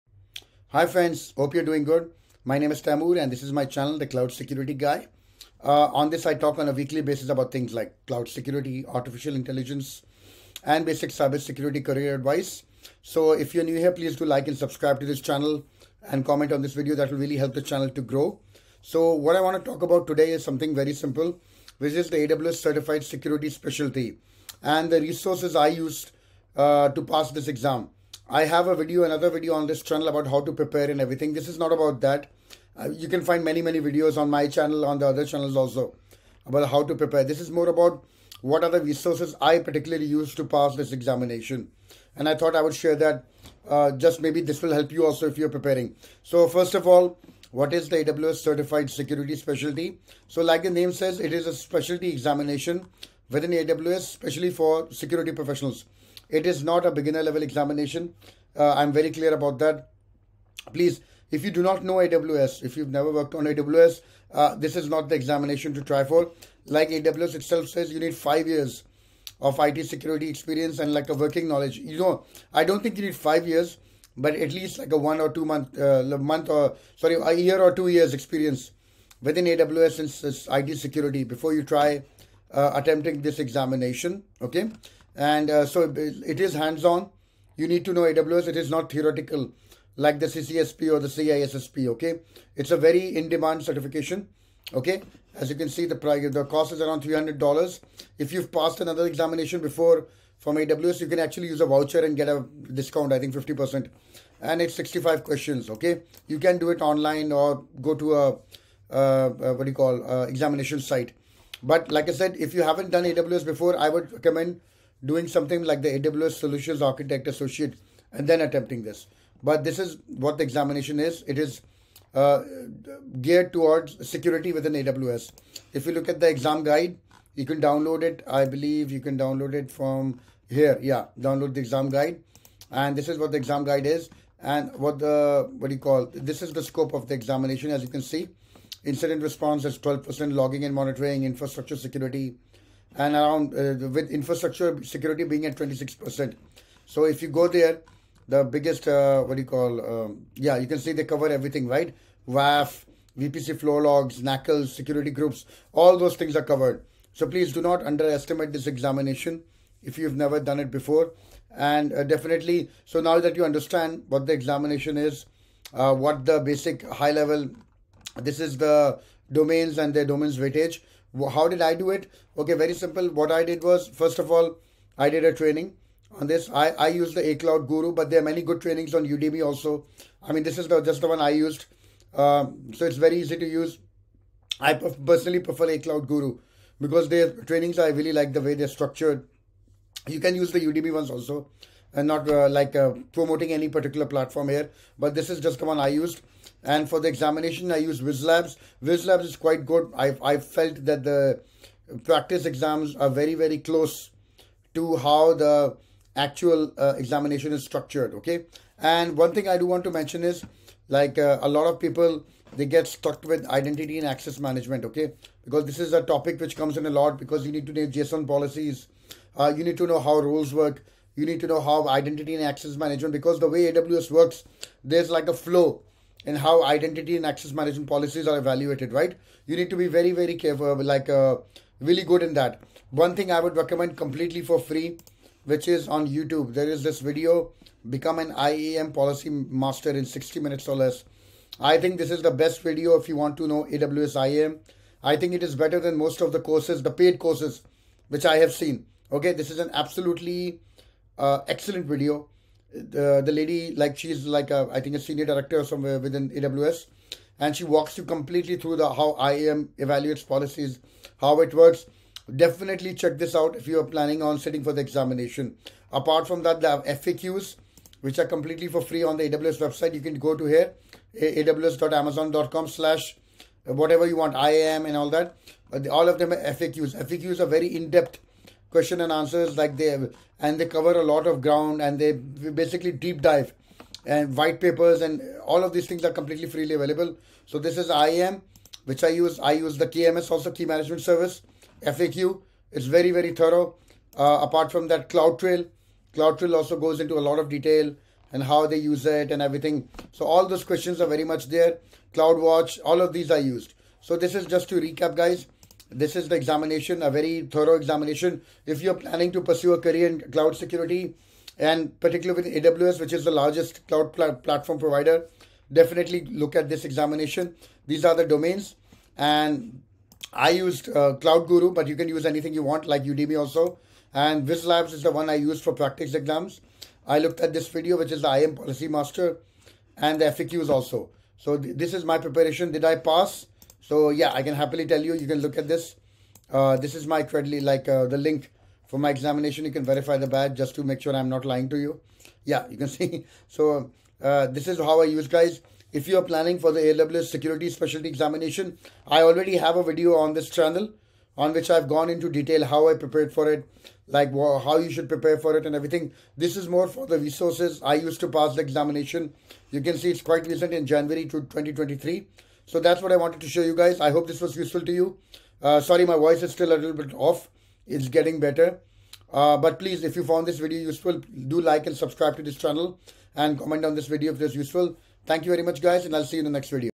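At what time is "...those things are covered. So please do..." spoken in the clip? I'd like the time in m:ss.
2:35.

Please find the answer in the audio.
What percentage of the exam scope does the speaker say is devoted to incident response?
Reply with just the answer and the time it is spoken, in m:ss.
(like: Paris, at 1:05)
12%, at 2:19.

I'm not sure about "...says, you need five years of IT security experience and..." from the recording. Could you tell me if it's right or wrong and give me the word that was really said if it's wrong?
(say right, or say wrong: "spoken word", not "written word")
right.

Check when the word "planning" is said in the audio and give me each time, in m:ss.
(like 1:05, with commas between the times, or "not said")
4:23, 5:08, 5:46.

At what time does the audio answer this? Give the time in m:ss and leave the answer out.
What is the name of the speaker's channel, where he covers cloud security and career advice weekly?
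0:03.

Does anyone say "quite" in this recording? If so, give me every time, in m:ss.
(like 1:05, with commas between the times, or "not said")
3:19, 6:00.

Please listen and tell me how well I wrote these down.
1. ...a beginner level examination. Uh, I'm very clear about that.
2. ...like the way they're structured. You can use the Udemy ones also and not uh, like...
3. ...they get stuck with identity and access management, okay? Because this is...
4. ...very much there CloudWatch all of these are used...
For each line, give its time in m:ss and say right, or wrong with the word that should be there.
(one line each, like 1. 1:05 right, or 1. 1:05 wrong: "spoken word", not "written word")
1. 0:56 right
2. 3:08 right
3. 3:32 right
4. 5:01 right.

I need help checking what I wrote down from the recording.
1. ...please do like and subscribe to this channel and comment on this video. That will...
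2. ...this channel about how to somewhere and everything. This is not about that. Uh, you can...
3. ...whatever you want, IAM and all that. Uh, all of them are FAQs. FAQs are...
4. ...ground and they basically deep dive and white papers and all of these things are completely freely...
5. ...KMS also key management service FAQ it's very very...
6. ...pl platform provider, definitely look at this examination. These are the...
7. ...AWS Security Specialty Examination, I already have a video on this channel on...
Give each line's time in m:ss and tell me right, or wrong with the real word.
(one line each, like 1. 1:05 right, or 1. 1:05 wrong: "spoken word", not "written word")
1. 0:13 right
2. 0:29 wrong: "prepare", not "somewhere"
3. 4:33 right
4. 4:41 right
5. 4:49 right
6. 5:14 right
7. 5:46 right.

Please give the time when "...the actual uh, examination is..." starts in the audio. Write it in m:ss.
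3:25.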